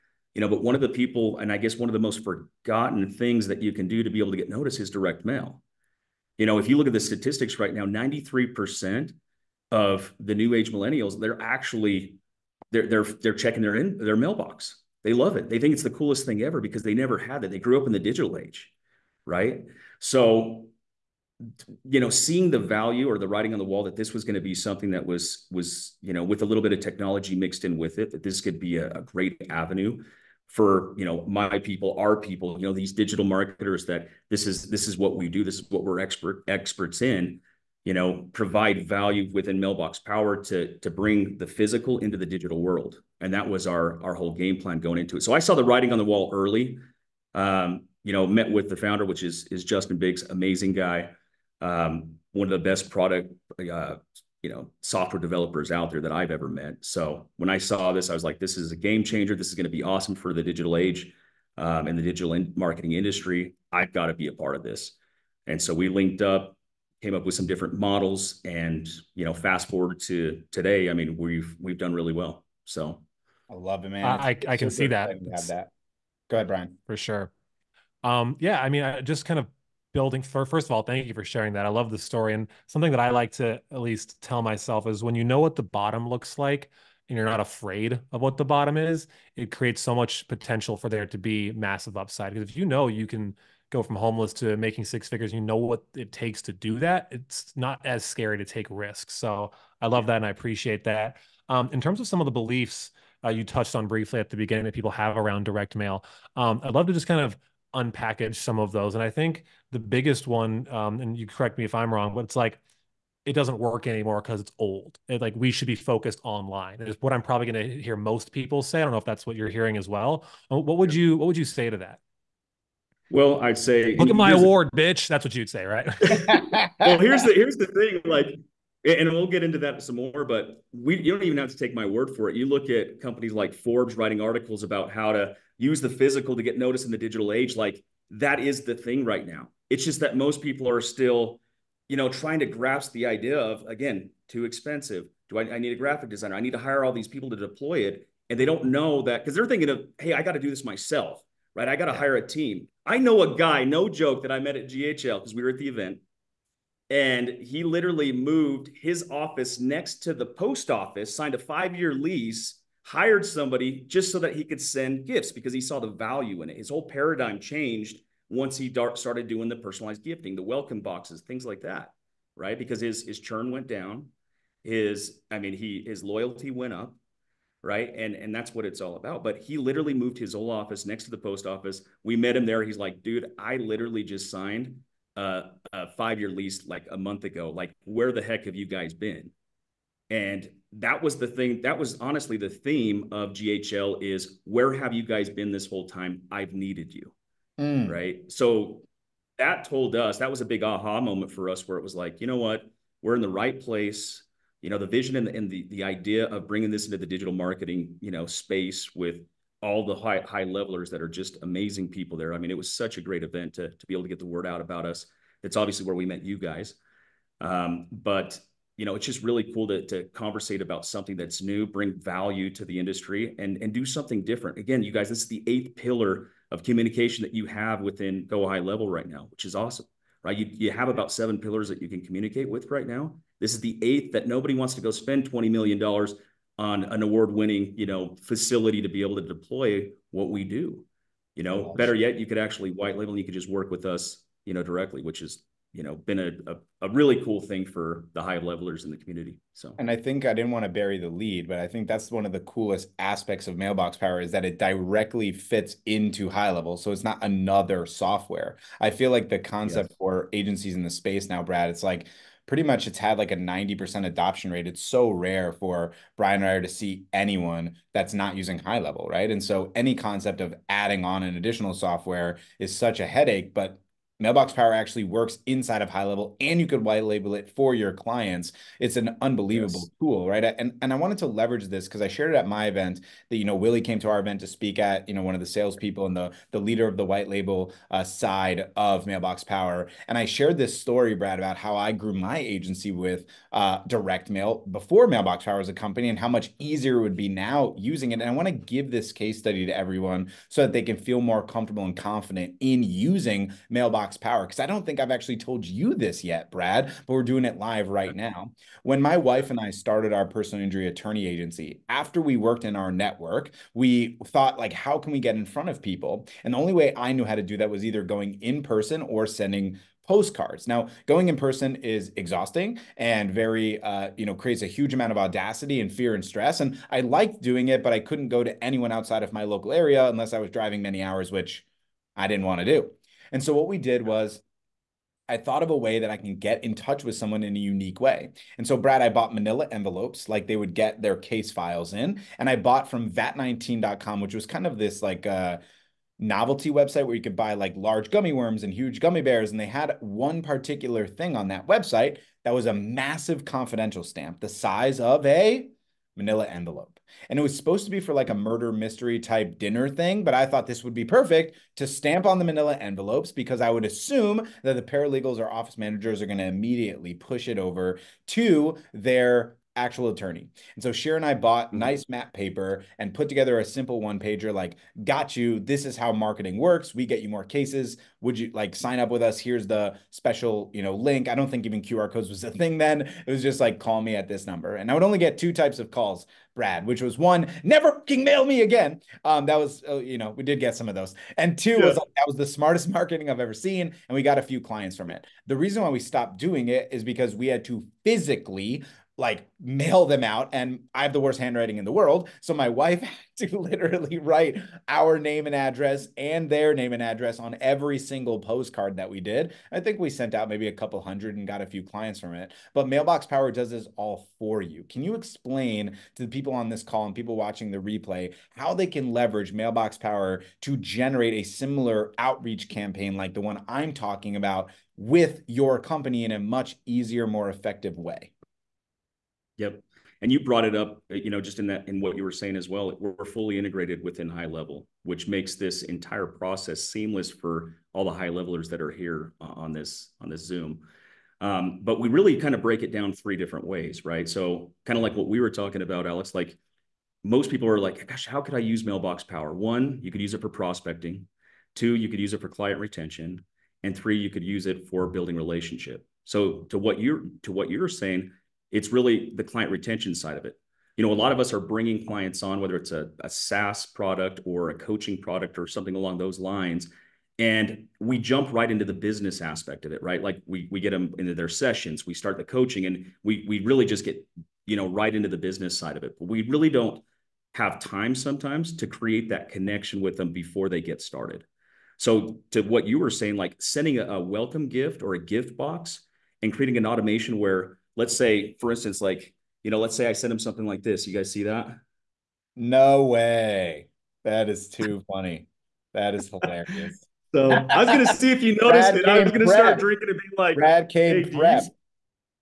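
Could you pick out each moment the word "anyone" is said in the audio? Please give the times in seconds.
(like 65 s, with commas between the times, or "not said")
267 s, 328 s.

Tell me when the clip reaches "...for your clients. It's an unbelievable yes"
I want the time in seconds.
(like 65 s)
277 s.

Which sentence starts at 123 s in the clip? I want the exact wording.
Well, I'd say look at my award, bitch.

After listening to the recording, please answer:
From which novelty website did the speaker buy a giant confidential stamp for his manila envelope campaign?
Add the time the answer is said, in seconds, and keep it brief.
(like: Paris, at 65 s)
vat19.com, at 343 s.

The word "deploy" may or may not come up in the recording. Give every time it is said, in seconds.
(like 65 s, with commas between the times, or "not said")
147 s, 239 s.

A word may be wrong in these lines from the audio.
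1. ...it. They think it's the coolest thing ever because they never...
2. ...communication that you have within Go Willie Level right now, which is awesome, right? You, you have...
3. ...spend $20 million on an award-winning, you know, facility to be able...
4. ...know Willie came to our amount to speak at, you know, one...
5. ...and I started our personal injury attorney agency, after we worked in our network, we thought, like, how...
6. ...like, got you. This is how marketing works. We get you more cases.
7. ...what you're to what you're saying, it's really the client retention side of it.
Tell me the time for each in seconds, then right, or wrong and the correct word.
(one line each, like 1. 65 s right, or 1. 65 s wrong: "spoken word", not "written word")
1. 15 s right
2. 226 s wrong: "High", not "Willie"
3. 234 s right
4. 283 s wrong: "event", not "amount"
5. 309 s right
6. 374 s right
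7. 456 s right.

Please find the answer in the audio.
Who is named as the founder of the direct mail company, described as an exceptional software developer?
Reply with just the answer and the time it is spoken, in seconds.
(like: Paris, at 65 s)
Justin Biggs, at 49 s.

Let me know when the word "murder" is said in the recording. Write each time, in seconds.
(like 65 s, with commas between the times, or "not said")
358 s.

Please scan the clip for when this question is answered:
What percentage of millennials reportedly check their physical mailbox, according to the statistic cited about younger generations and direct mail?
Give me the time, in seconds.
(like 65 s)
7 s.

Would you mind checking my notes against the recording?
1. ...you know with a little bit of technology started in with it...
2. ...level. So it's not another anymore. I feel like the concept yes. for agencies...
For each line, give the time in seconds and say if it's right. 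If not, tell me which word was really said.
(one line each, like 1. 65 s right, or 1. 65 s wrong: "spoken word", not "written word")
1. 26 s wrong: "mixed", not "started"
2. 256 s wrong: "software", not "anymore".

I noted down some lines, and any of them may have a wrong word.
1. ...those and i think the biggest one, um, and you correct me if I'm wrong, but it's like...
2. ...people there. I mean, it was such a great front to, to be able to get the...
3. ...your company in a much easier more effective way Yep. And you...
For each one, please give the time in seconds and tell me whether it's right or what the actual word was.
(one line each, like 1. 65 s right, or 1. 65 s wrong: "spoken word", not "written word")
1. 108 s right
2. 211 s wrong: "event", not "front"
3. 425 s right.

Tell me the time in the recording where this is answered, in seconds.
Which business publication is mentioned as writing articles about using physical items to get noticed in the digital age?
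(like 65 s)
133 s.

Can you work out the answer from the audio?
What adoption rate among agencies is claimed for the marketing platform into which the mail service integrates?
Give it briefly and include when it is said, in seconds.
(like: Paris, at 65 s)
90%, at 263 s.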